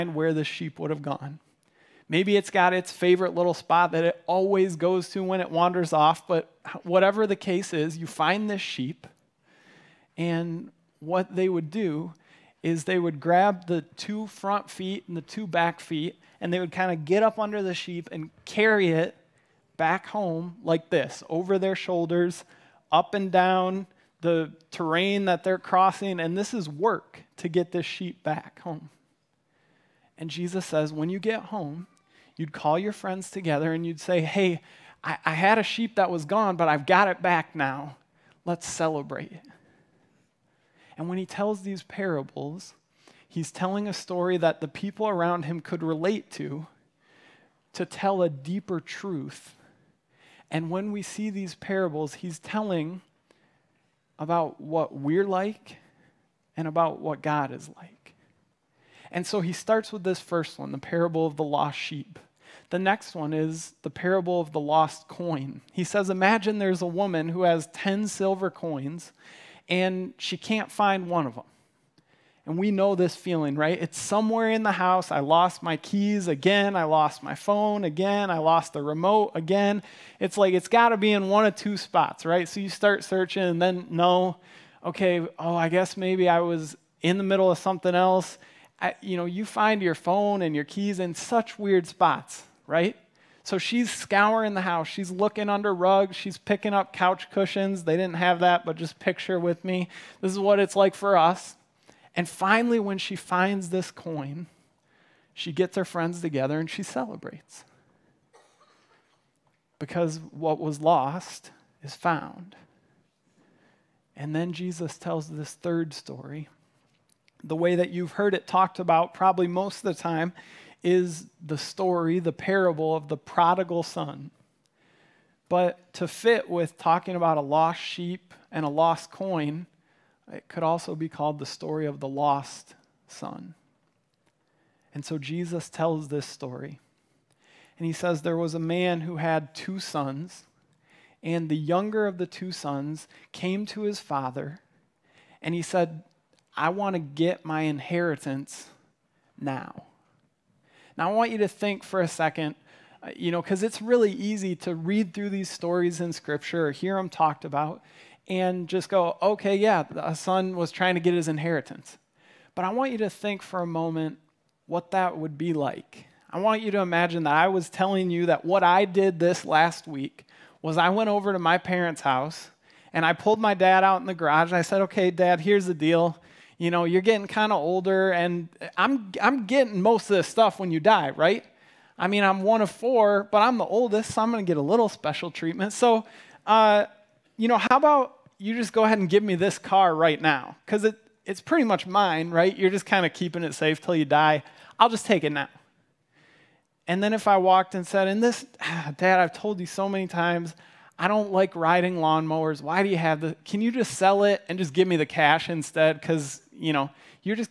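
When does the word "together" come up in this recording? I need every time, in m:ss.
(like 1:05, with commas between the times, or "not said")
0:33, 1:46.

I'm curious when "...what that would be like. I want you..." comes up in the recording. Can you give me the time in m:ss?
2:44.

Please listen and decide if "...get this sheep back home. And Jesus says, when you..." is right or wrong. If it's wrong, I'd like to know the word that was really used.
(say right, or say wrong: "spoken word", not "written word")
right.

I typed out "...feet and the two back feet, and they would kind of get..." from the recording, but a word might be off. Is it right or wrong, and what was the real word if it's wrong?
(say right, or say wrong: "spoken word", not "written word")
right.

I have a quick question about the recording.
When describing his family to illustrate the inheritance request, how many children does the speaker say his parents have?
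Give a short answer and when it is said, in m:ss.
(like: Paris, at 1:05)
4, at 3:02.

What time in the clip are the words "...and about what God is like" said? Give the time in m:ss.
0:56.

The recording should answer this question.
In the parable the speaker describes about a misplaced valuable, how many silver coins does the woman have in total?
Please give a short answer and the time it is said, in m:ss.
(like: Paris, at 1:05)
10, at 1:07.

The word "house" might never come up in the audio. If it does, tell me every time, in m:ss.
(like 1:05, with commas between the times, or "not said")
1:14, 1:34, 2:52.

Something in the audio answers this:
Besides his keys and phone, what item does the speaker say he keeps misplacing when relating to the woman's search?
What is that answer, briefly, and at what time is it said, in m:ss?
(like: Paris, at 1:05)
The remote, at 1:18.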